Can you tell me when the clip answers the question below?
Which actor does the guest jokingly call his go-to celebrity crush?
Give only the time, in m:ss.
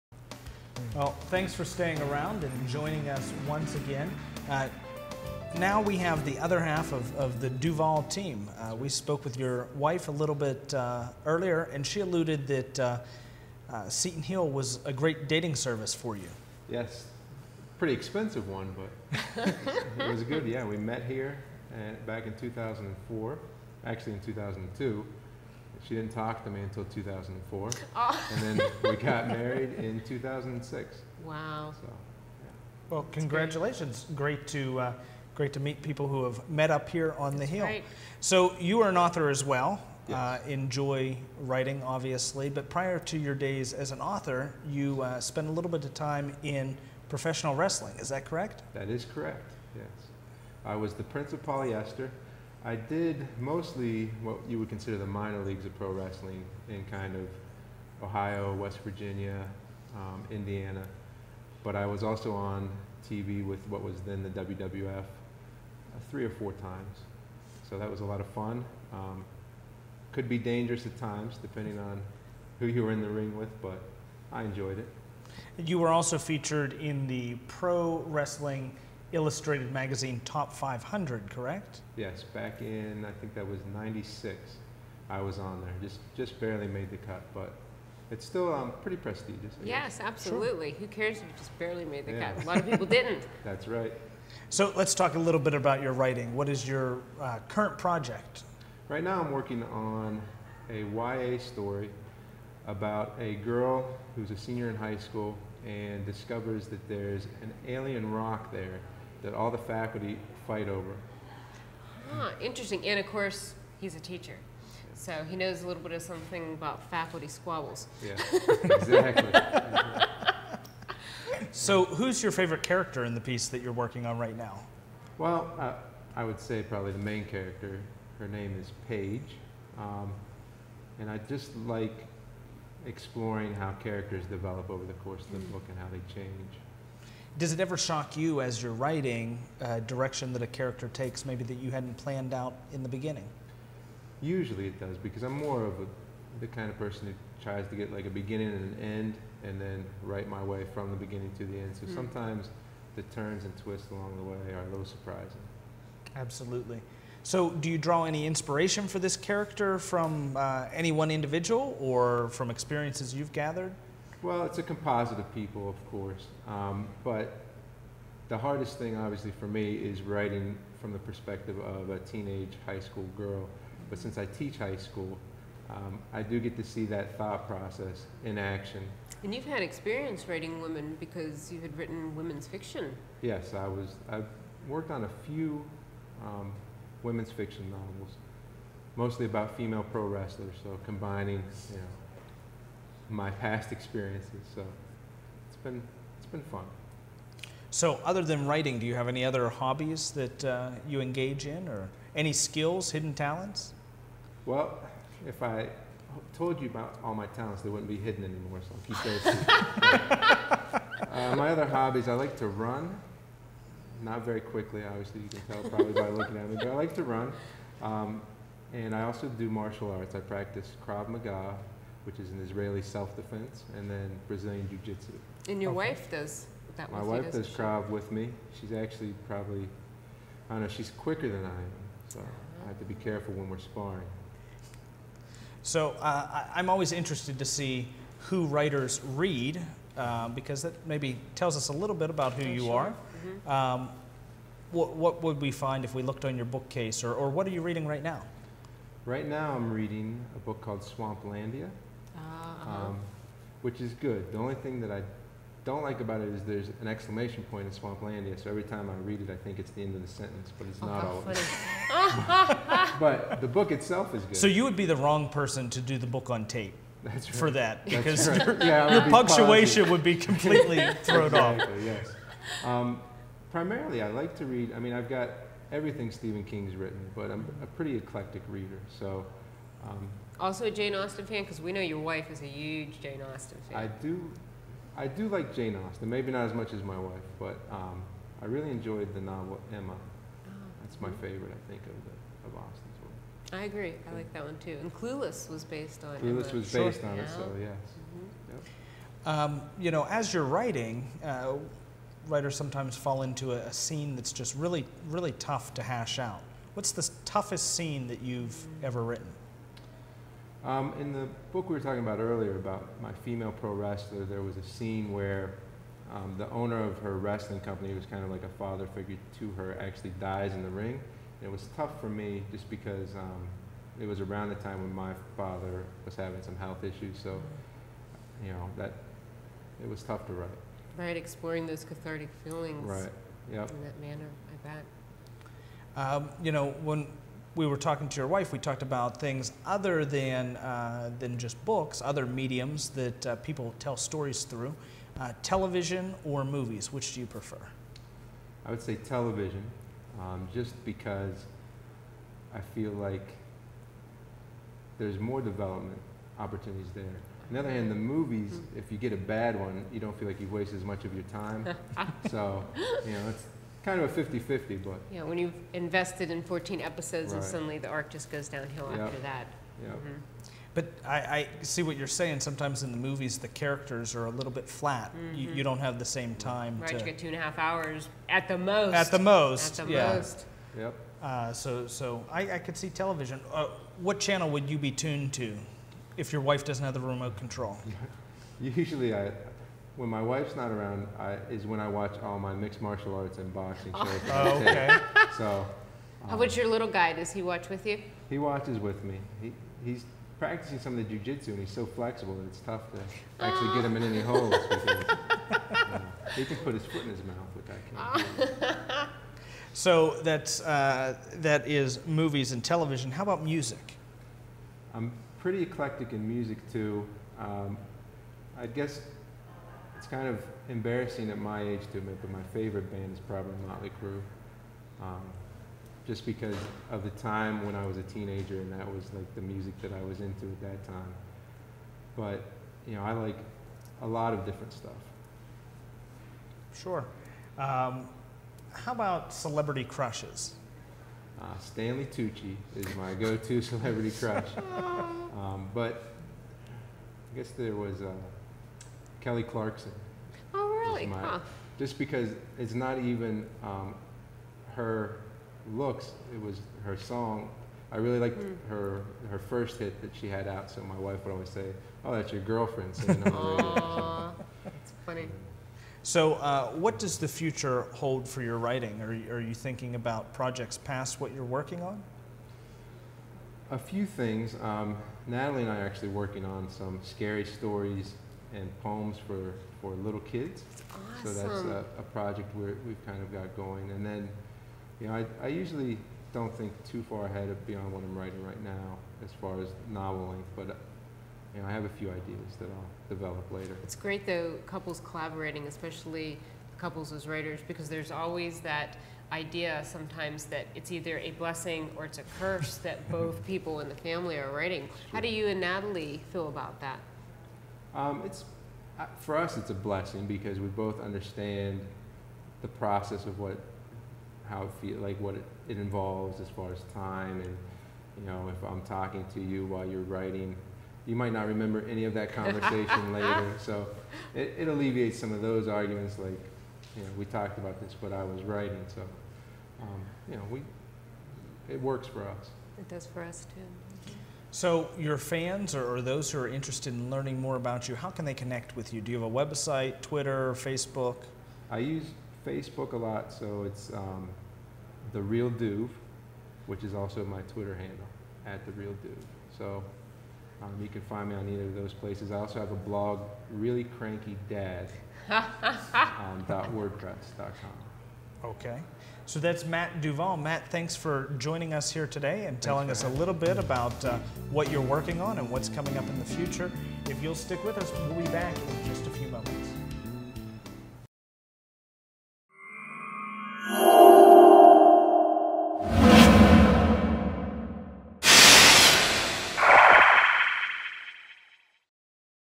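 7:21.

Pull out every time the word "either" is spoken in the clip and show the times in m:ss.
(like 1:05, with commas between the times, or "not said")
8:20, 9:11.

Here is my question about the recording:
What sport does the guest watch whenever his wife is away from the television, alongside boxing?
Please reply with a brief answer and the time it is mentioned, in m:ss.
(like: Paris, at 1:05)
mixed martial arts, at 6:32.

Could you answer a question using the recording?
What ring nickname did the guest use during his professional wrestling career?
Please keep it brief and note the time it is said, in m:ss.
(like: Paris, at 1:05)
Prince of Polyester, at 0:51.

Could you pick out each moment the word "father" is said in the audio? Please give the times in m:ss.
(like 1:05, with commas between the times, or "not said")
5:18, 5:25.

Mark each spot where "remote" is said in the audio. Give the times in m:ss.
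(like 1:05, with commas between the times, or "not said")
6:27.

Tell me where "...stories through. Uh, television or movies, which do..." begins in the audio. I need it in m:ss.
5:43.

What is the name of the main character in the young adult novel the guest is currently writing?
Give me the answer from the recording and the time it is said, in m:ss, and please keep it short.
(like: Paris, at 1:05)
Paige, at 2:08.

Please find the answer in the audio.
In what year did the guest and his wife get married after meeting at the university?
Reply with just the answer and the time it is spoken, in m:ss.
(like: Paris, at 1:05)
2006, at 0:30.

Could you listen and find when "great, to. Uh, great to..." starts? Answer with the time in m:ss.
0:34.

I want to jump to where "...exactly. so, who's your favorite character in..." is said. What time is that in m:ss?
1:58.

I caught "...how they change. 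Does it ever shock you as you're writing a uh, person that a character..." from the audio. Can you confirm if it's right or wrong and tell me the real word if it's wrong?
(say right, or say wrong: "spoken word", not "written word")
wrong: "direction", not "person".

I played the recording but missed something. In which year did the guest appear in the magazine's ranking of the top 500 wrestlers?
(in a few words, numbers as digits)
1996.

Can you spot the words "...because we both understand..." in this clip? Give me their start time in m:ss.
8:30.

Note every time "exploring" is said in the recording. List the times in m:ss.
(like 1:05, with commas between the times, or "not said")
2:12, 5:31.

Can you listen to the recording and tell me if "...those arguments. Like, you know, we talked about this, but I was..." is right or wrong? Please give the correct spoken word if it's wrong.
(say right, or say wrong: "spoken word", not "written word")
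right.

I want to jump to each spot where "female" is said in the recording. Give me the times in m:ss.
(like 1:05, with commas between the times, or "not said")
3:09, 5:13.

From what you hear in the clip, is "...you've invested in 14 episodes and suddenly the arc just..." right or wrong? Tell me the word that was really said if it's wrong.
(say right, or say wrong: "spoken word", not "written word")
right.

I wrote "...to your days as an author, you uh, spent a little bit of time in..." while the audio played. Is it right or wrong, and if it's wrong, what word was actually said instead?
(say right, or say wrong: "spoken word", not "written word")
right.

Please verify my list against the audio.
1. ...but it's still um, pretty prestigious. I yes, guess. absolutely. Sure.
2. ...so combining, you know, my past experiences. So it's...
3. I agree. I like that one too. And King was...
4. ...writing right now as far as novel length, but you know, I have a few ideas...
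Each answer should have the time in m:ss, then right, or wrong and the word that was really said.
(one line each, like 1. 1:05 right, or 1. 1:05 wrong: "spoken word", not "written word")
1. 1:27 right
2. 3:10 right
3. 4:53 wrong: "Clueless", not "King"
4. 8:08 right.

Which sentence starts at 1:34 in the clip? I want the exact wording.
So let's talk a little bit about your writing.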